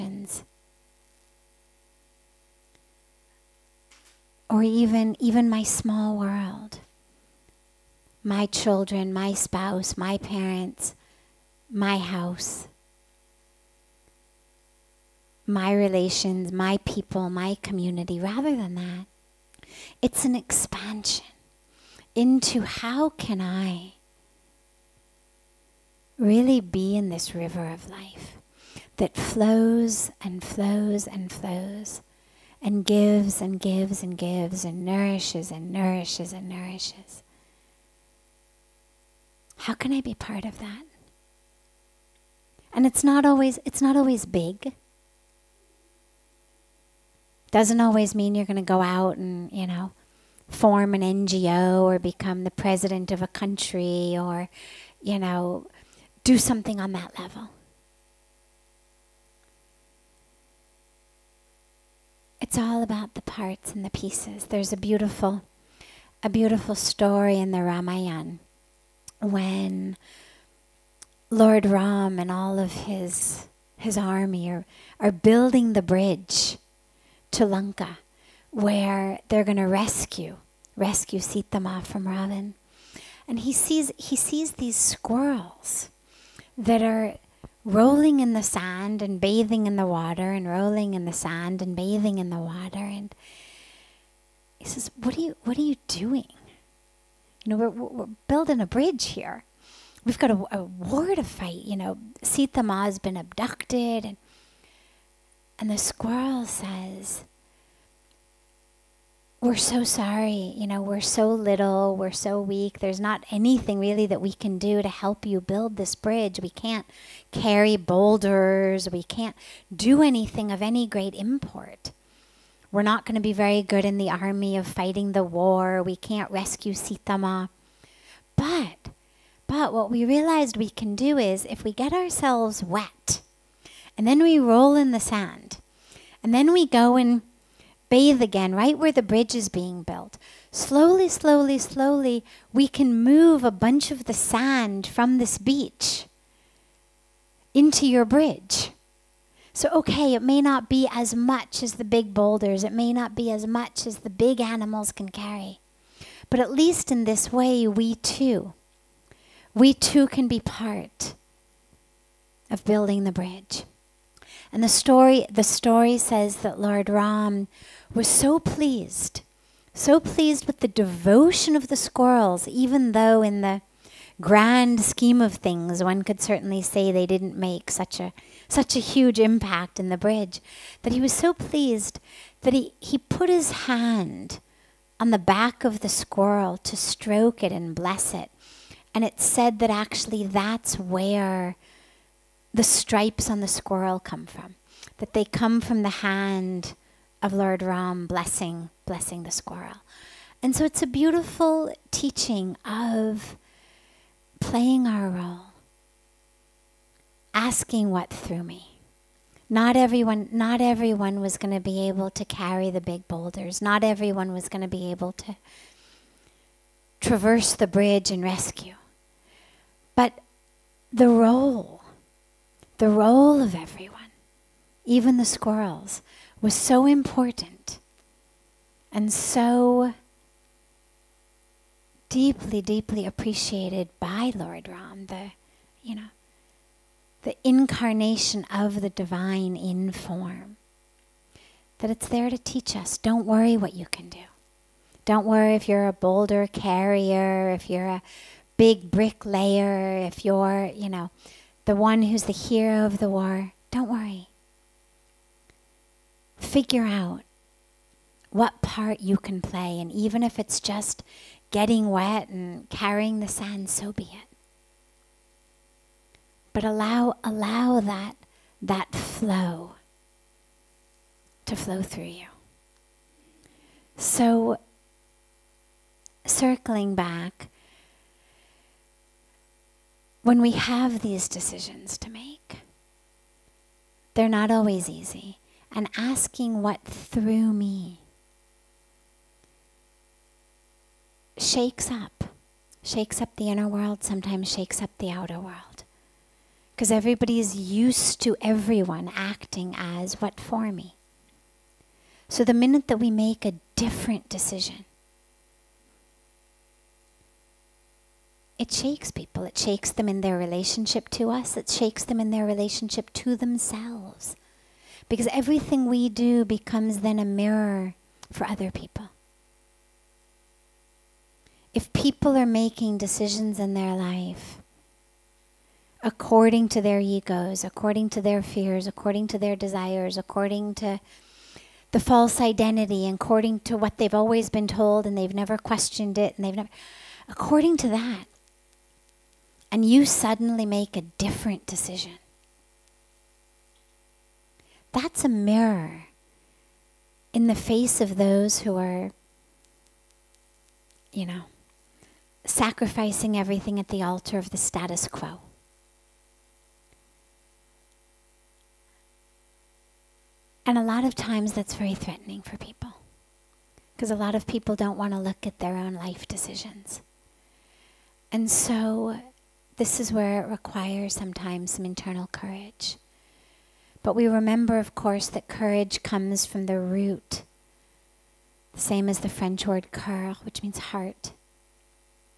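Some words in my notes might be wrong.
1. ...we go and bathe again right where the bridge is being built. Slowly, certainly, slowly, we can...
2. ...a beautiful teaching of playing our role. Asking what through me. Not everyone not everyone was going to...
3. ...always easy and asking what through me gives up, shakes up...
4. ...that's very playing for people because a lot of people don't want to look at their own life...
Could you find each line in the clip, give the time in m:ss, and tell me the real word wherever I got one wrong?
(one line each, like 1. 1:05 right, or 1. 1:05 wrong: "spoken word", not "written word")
1. 2:16 wrong: "slowly", not "certainly"
2. 3:20 right
3. 4:44 wrong: "shakes", not "gives"
4. 6:01 wrong: "threatening", not "playing".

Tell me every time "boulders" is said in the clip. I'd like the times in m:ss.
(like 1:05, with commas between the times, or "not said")
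1:57, 2:32, 3:33, 4:05.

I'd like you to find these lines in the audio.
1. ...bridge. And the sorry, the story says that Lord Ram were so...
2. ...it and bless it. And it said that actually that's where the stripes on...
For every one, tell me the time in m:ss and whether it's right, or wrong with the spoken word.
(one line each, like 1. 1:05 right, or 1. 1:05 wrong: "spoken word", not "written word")
1. 2:43 wrong: "story", not "sorry"
2. 3:07 right.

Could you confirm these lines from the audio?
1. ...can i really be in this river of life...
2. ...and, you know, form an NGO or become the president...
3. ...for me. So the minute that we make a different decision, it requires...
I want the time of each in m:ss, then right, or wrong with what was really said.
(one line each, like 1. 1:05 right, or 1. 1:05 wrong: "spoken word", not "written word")
1. 0:23 right
2. 0:49 right
3. 5:00 wrong: "shakes", not "requires".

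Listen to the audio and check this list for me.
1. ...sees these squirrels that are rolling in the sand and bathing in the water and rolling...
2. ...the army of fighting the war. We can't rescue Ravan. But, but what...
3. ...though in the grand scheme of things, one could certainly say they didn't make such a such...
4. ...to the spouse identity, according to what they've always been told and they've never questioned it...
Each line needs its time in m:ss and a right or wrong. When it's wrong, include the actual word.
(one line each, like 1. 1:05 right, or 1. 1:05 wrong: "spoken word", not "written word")
1. 1:24 right
2. 2:03 wrong: "Sitama", not "Ravan"
3. 2:52 right
4. 5:30 wrong: "false", not "spouse".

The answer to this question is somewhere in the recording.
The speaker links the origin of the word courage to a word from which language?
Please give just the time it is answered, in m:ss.
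6:19.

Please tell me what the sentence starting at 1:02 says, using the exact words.
it's all about the parts and the pieces.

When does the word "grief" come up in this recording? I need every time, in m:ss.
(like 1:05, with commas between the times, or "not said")
not said.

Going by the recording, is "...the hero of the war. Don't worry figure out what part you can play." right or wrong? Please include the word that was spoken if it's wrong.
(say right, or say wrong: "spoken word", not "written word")
right.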